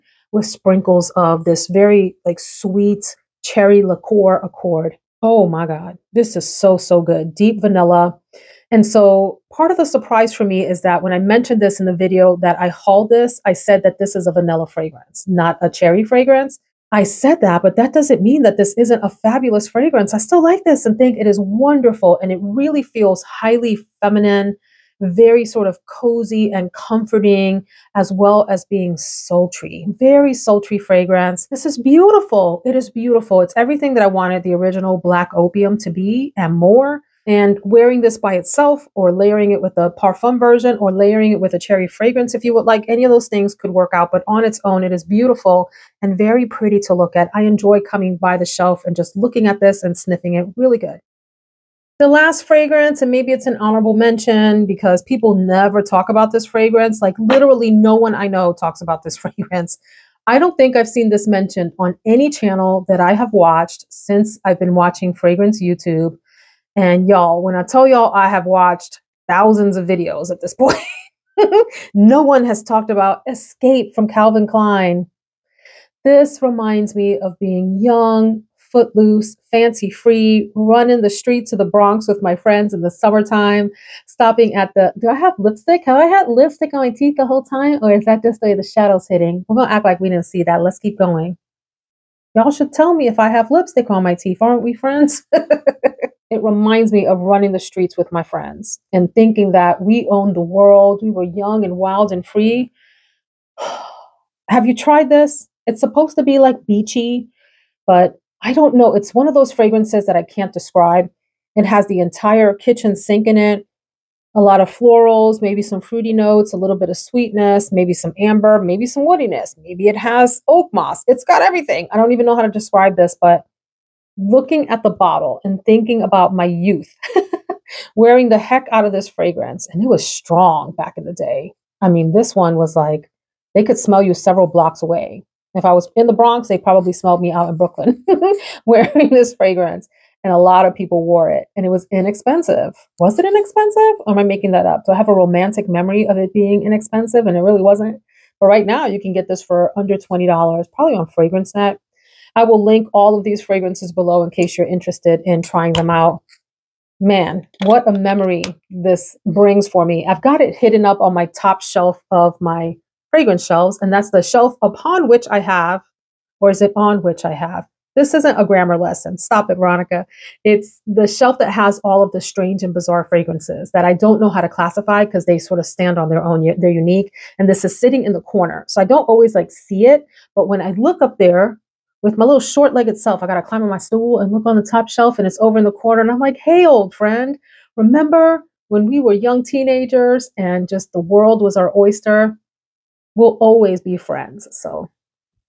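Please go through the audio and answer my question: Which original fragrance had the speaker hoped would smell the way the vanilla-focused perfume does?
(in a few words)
Black Opium.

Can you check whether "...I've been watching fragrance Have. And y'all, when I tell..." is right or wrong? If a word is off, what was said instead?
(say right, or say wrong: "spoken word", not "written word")
wrong: "YouTube", not "Have".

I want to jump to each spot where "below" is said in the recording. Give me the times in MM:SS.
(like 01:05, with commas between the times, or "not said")
02:33.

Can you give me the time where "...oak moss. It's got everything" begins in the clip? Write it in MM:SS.
02:00.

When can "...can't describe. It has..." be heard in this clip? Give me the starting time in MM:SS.
01:50.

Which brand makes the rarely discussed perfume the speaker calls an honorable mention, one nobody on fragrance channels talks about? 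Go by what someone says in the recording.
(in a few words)
Calvin Klein.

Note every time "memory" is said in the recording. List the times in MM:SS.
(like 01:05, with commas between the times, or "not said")
02:25, 02:37.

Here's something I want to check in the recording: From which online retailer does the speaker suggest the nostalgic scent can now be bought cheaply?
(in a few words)
FragranceNet.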